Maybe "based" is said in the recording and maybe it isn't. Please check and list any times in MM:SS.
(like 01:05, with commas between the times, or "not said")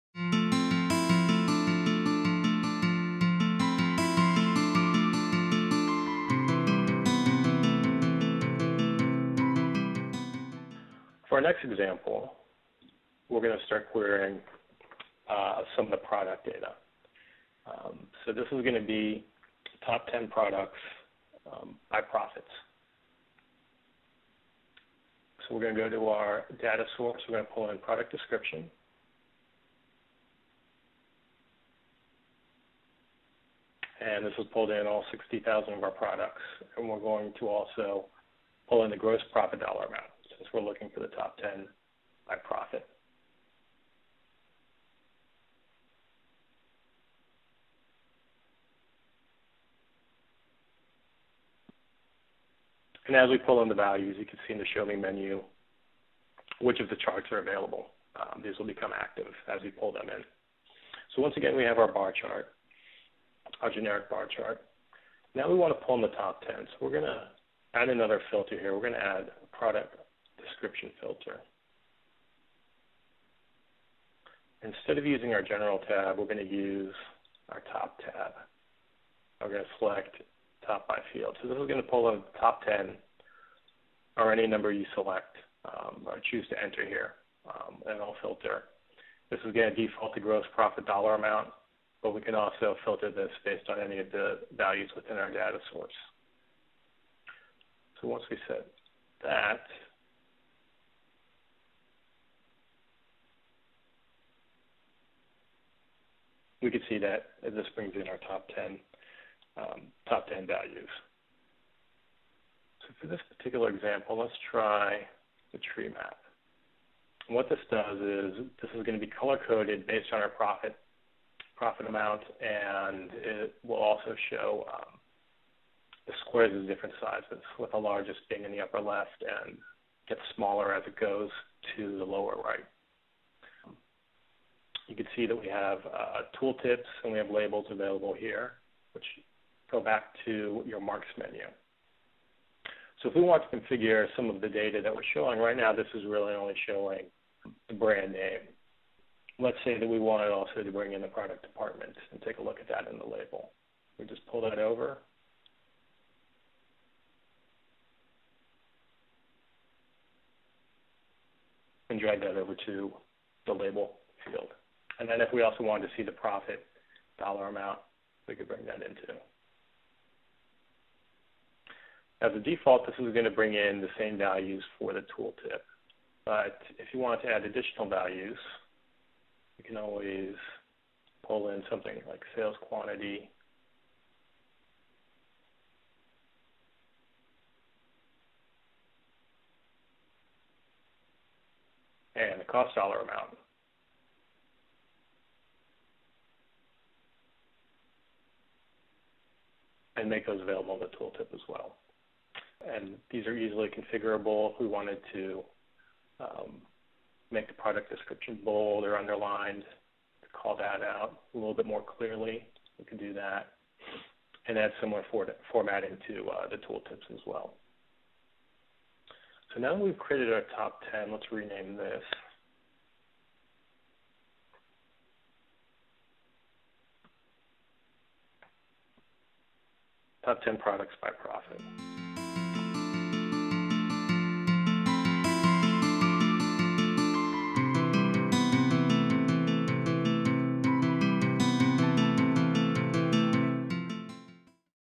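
01:33, 01:59.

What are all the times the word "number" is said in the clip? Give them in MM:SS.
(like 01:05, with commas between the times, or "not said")
01:24.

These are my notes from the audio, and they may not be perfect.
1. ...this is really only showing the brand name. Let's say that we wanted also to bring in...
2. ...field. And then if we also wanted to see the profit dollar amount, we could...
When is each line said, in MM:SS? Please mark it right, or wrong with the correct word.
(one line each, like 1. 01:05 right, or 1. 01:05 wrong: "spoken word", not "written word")
1. 02:25 right
2. 02:44 right.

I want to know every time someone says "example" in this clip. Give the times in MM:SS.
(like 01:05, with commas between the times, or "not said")
00:11, 01:53.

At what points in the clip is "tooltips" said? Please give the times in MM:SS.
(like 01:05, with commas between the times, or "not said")
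02:16, 02:55, 03:20, 03:36.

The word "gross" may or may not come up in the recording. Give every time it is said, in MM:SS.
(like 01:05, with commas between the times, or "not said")
00:38, 01:30.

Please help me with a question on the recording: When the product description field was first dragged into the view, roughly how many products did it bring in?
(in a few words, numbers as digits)
60,000.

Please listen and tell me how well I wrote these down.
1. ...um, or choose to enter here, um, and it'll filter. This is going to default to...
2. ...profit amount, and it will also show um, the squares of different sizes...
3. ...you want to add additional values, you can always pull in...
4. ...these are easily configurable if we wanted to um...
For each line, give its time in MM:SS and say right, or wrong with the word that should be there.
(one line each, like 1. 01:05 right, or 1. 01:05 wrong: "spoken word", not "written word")
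1. 01:25 right
2. 02:01 right
3. 02:56 right
4. 03:23 right.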